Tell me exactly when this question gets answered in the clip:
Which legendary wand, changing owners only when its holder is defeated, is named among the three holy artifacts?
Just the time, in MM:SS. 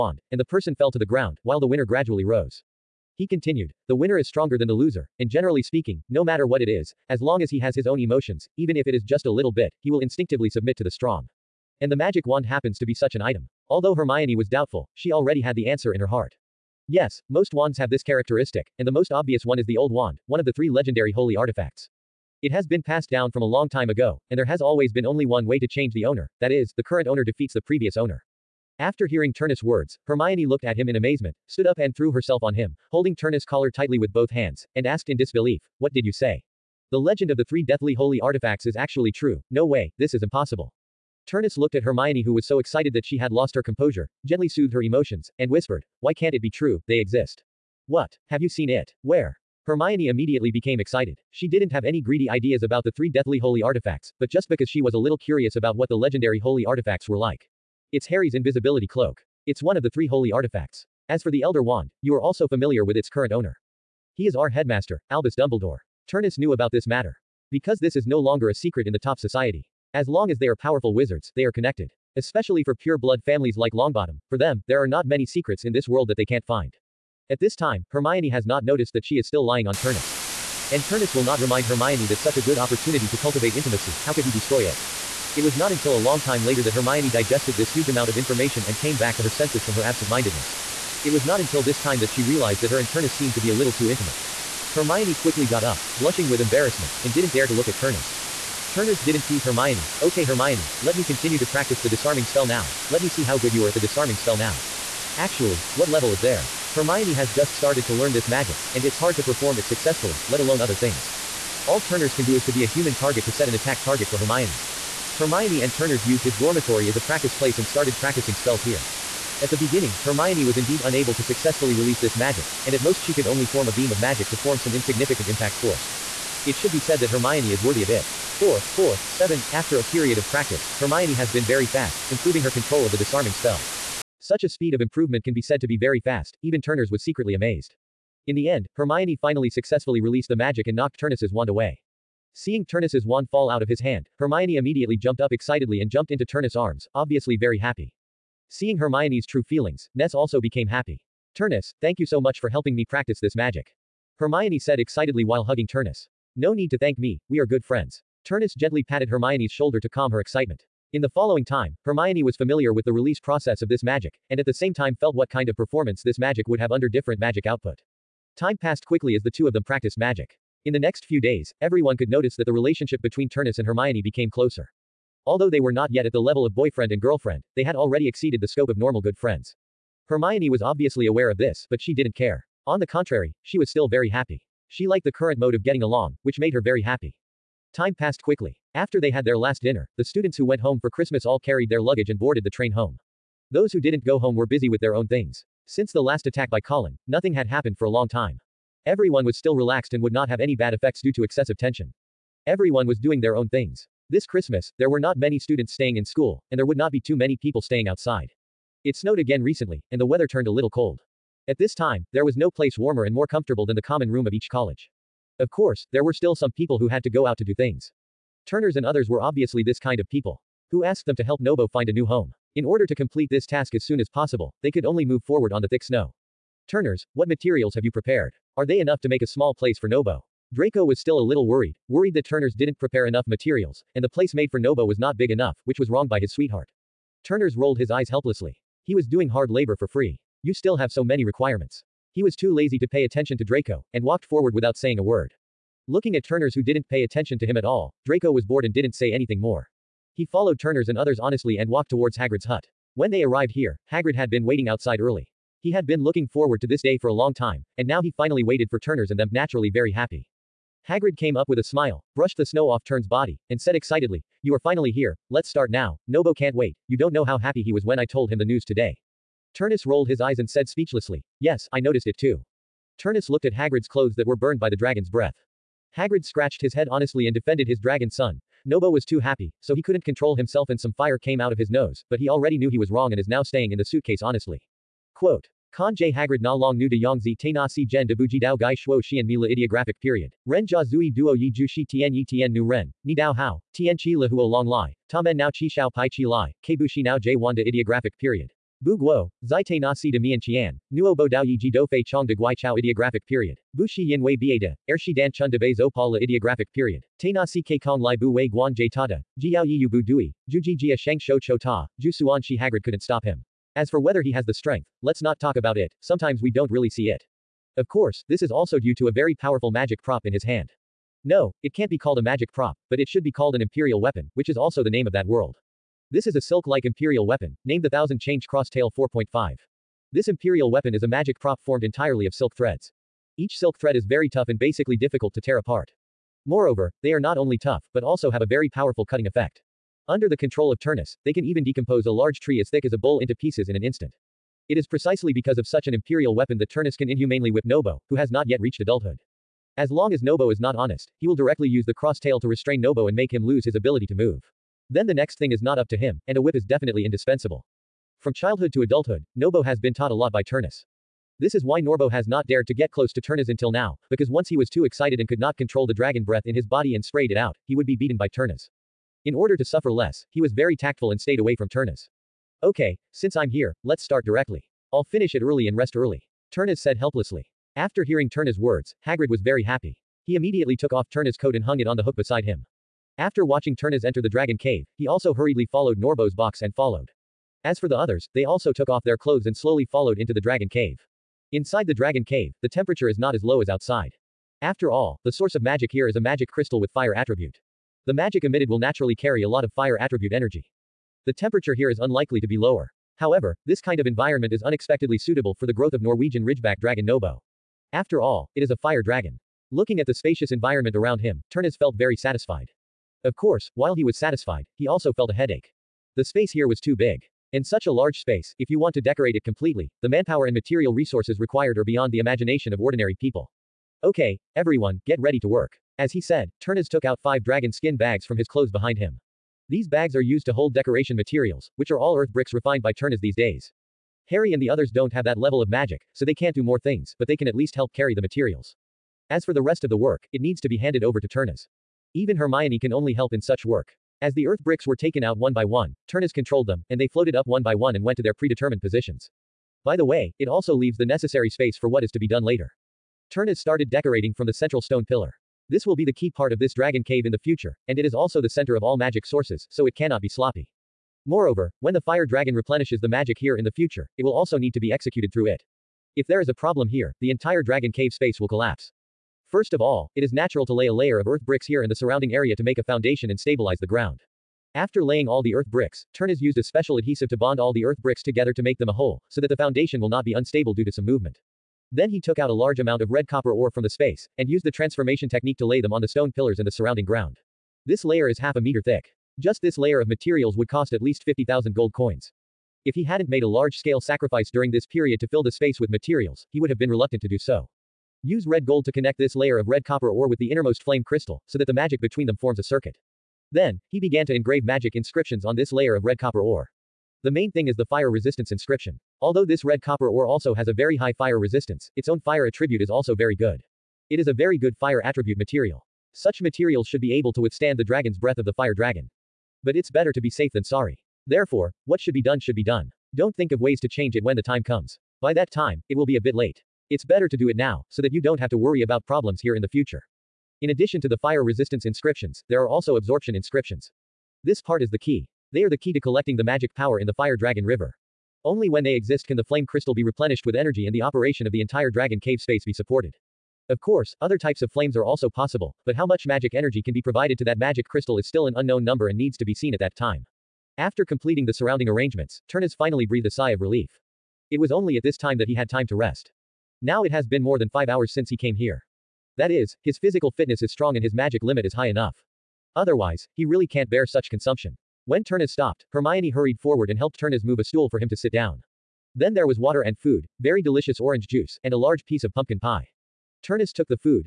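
00:19.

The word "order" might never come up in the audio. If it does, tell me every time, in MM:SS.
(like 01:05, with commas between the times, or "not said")
03:42, 06:09.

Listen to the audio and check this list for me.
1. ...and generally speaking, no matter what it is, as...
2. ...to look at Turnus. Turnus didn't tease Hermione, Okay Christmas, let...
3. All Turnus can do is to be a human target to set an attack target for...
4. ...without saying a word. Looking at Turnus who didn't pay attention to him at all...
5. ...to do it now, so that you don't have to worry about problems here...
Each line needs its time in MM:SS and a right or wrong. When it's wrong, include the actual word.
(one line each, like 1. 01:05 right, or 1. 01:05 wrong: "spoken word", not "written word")
1. 00:05 right
2. 01:37 wrong: "Hermione", not "Christmas"
3. 01:51 right
4. 04:04 right
5. 08:47 right.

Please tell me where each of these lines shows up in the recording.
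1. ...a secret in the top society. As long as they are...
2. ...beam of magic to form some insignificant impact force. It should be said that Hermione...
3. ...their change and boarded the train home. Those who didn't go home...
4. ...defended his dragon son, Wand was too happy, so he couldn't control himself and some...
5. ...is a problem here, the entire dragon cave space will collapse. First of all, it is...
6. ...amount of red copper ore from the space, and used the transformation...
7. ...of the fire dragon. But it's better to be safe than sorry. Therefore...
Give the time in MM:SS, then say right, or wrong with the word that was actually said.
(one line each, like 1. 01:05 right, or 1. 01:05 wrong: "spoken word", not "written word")
1. 01:08 right
2. 02:03 right
3. 03:11 wrong: "luggage", not "change"
4. 04:37 wrong: "Nobo", not "Wand"
5. 07:46 right
6. 08:02 right
7. 08:38 right.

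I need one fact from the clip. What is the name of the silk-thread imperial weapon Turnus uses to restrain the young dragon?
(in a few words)
Thousand Change Crosstail.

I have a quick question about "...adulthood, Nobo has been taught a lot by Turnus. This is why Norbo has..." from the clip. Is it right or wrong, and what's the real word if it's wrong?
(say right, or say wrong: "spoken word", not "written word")
right.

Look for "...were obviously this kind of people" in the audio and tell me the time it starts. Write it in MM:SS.
03:39.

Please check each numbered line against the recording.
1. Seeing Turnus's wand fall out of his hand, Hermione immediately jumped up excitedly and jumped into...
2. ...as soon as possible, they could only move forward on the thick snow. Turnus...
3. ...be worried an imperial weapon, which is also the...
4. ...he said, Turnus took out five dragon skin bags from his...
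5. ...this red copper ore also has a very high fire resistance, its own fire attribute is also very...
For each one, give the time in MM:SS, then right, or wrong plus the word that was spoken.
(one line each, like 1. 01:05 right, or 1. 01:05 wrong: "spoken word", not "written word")
1. 02:22 right
2. 03:43 right
3. 05:23 wrong: "called", not "worried"
4. 07:06 right
5. 08:29 right.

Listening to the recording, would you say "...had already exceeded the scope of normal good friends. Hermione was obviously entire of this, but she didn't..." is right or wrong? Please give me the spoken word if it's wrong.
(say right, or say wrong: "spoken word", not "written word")
wrong: "aware", not "entire".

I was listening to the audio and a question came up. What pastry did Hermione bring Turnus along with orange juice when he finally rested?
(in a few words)
pumpkin pie.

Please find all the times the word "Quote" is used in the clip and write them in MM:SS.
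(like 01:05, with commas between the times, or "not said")
04:45.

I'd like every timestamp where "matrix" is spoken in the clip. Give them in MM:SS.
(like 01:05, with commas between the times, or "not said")
not said.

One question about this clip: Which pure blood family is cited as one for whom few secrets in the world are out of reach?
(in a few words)
Longbottom.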